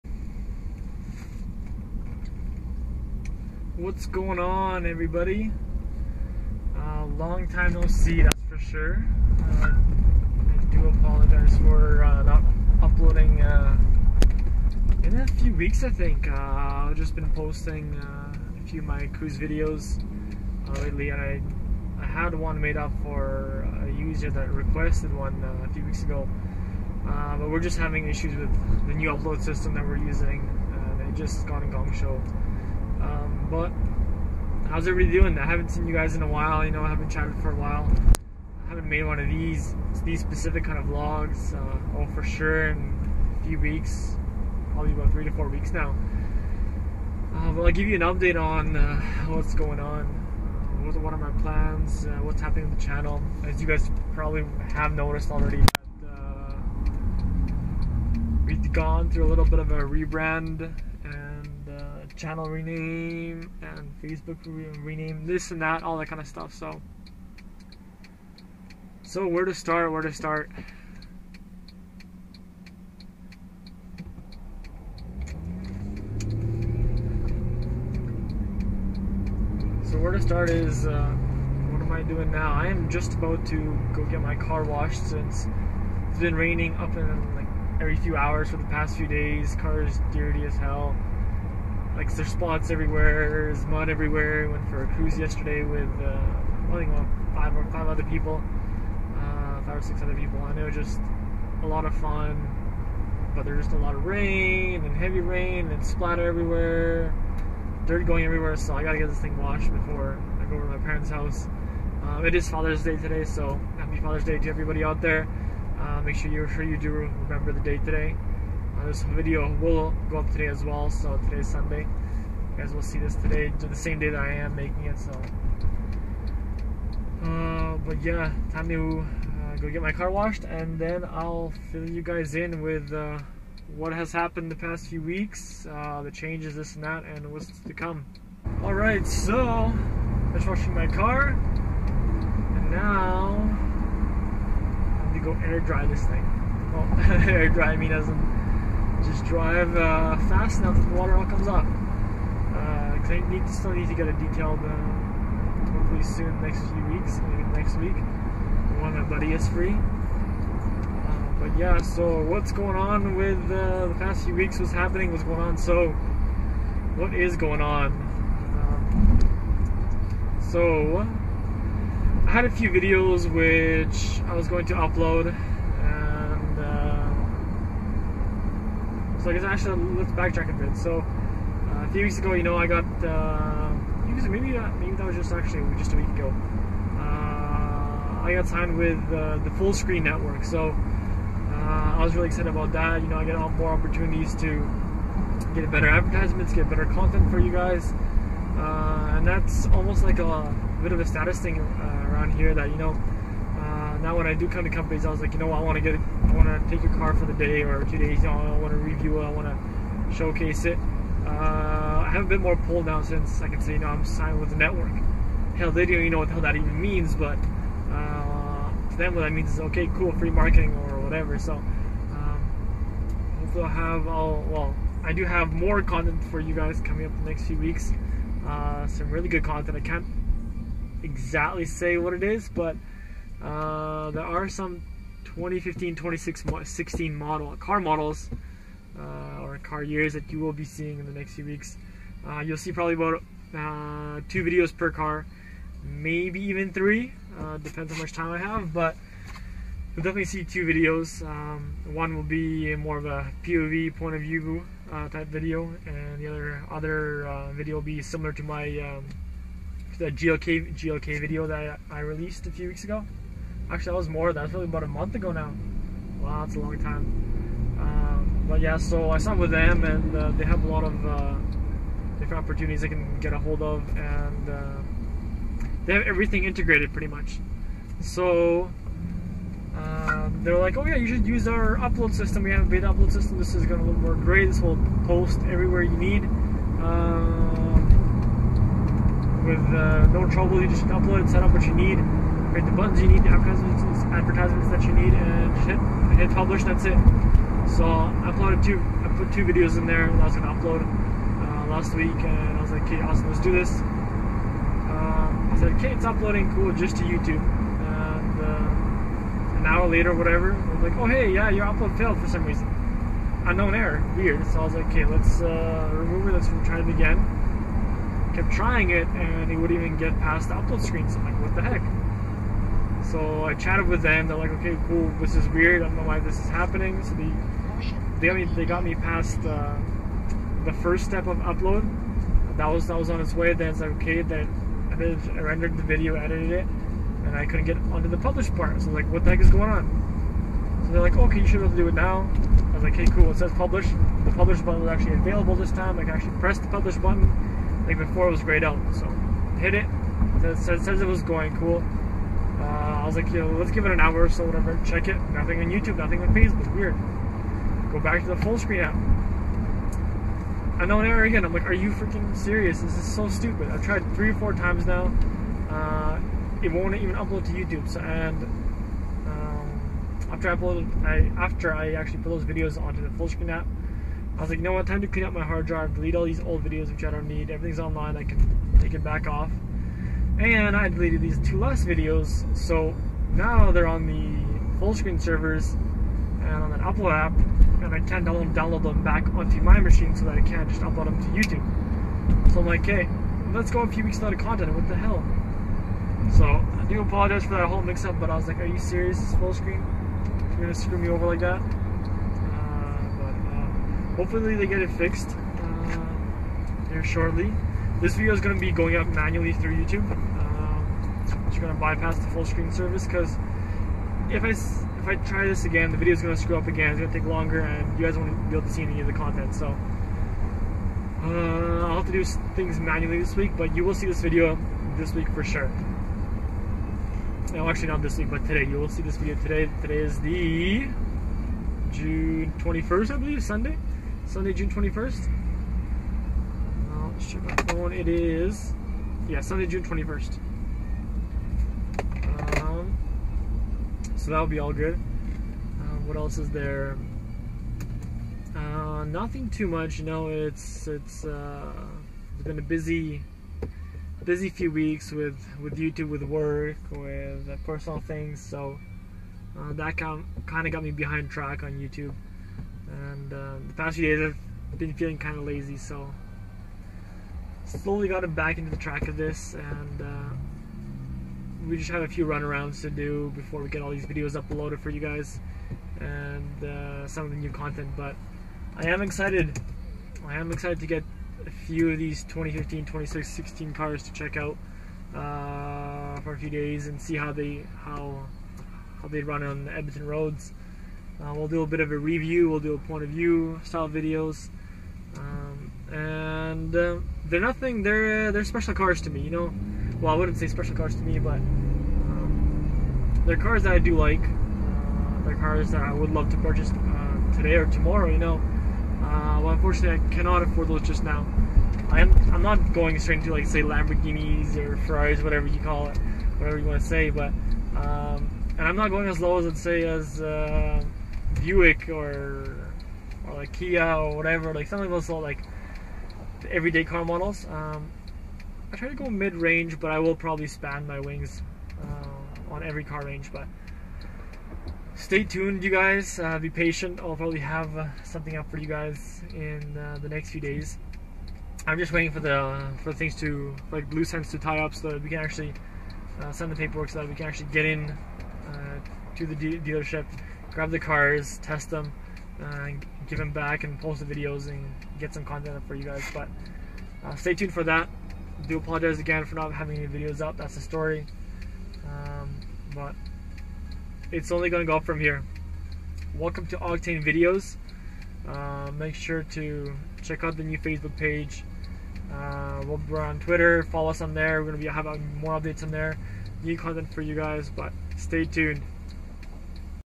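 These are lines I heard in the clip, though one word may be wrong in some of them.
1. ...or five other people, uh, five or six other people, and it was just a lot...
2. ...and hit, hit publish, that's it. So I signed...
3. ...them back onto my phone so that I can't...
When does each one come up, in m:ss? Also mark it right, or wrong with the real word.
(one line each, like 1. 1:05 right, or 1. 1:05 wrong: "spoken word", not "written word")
1. 1:37 right
2. 4:55 wrong: "uploaded", not "signed"
3. 6:28 wrong: "machine", not "phone".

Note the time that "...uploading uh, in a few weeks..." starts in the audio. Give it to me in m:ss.
0:12.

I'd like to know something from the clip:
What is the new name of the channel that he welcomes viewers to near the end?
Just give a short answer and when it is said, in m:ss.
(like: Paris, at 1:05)
Octane Videos, at 9:26.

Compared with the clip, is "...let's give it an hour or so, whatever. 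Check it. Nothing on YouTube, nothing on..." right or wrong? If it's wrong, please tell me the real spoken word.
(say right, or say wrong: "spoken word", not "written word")
right.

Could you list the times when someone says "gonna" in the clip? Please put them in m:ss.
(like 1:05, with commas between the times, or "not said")
4:43, 6:40, 6:48.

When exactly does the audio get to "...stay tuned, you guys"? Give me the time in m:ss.
8:54.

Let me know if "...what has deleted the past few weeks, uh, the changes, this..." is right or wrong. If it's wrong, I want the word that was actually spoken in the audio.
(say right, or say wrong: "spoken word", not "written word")
wrong: "happened", not "deleted".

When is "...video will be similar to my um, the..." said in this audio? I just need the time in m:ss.
4:17.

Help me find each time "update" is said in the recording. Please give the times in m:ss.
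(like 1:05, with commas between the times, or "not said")
0:48, 9:35.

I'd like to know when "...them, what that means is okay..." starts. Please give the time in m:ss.
3:38.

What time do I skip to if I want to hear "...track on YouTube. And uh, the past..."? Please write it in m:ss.
7:41.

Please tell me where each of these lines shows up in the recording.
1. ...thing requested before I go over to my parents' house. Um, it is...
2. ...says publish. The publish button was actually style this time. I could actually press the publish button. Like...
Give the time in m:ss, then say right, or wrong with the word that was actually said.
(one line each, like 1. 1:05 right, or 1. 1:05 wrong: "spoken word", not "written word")
1. 1:49 wrong: "washed", not "requested"
2. 5:43 wrong: "available", not "style".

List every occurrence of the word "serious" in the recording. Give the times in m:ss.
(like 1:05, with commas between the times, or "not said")
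6:02, 6:38.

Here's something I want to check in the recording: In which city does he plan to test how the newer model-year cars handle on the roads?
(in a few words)
Edmonton.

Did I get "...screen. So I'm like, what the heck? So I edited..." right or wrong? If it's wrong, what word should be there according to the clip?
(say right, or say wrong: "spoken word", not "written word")
wrong: "chatted", not "edited".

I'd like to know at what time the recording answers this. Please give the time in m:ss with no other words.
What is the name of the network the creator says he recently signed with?
3:09.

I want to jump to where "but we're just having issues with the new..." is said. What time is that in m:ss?
0:27.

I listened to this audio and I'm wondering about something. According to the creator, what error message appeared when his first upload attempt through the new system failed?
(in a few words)
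Unknown error.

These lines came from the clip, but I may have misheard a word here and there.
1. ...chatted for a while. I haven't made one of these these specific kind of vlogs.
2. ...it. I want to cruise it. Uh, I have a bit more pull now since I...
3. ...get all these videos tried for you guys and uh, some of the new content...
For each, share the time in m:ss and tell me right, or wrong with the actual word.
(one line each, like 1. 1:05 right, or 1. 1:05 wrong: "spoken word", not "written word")
1. 0:37 right
2. 3:29 wrong: "showcase", not "cruise"
3. 7:53 wrong: "uploaded", not "tried".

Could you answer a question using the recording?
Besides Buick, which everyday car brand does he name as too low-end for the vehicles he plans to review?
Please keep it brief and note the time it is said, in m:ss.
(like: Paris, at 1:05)
Kia, at 8:43.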